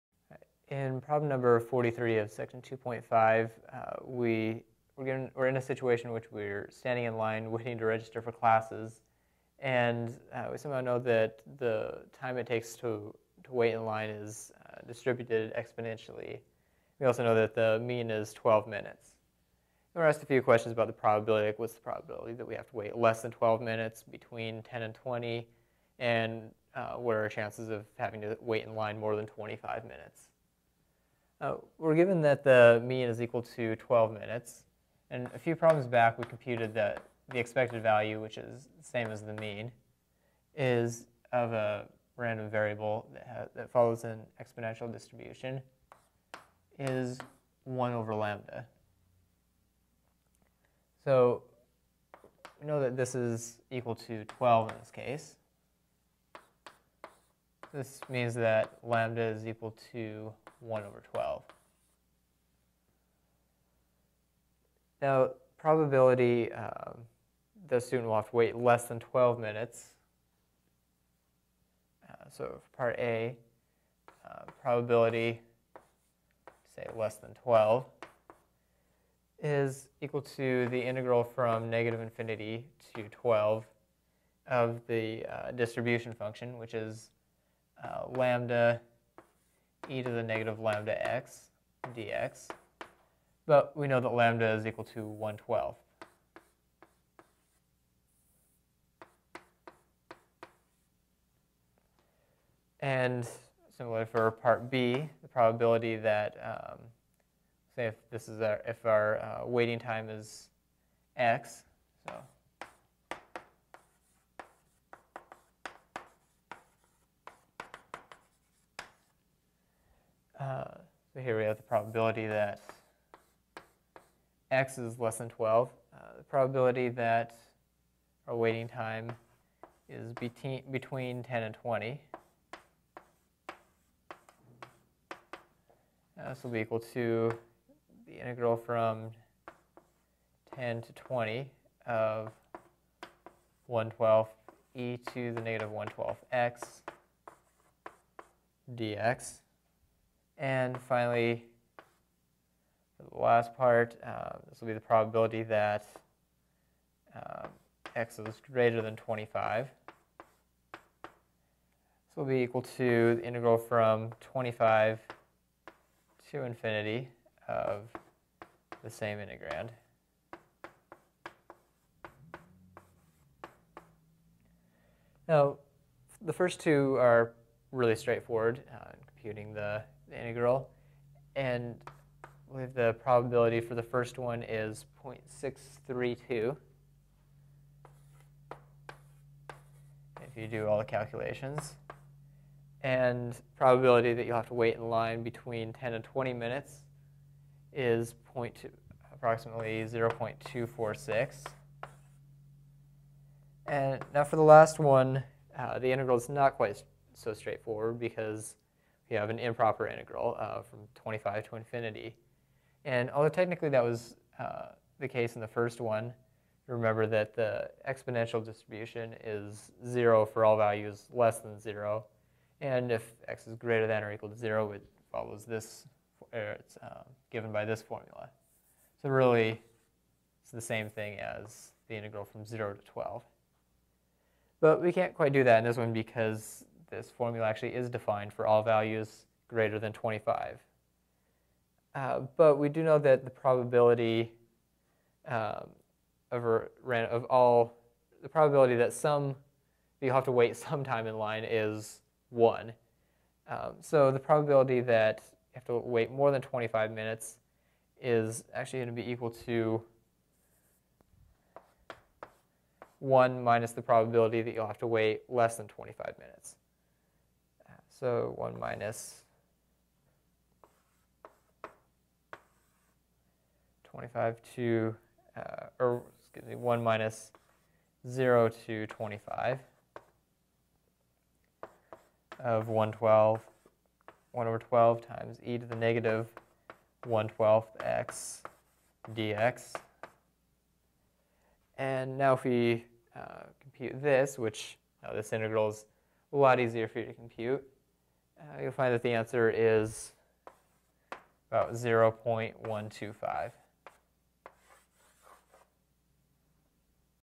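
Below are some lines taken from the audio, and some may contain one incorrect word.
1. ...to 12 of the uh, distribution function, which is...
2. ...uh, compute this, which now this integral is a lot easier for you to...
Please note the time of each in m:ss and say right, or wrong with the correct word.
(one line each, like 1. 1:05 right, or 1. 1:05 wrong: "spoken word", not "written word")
1. 1:22 right
2. 4:53 right.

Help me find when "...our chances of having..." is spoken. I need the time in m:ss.
0:27.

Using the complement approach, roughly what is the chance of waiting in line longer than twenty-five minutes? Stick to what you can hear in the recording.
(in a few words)
0.125.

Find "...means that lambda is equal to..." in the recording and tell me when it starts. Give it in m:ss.
0:58.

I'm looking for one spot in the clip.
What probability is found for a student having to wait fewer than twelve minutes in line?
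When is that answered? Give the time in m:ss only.
3:05.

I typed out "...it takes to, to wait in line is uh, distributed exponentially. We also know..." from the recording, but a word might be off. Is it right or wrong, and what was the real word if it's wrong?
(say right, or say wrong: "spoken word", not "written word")
right.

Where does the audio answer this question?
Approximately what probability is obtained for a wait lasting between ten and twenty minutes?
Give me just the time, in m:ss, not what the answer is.
3:19.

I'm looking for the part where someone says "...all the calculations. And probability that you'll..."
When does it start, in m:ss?
3:10.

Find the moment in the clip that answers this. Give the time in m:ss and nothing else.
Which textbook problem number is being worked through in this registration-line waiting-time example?
0:01.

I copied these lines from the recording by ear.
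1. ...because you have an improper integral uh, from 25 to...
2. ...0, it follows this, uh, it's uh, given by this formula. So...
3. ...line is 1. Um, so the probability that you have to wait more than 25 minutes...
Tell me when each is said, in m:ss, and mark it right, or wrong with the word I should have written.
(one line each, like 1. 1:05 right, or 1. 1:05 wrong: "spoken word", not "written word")
1. 3:27 right
2. 3:44 right
3. 4:11 right.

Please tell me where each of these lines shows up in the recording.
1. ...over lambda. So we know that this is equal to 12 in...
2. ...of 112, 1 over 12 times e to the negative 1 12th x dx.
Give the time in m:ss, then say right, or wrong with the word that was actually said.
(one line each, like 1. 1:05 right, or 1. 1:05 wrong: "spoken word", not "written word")
1. 0:47 right
2. 4:42 right.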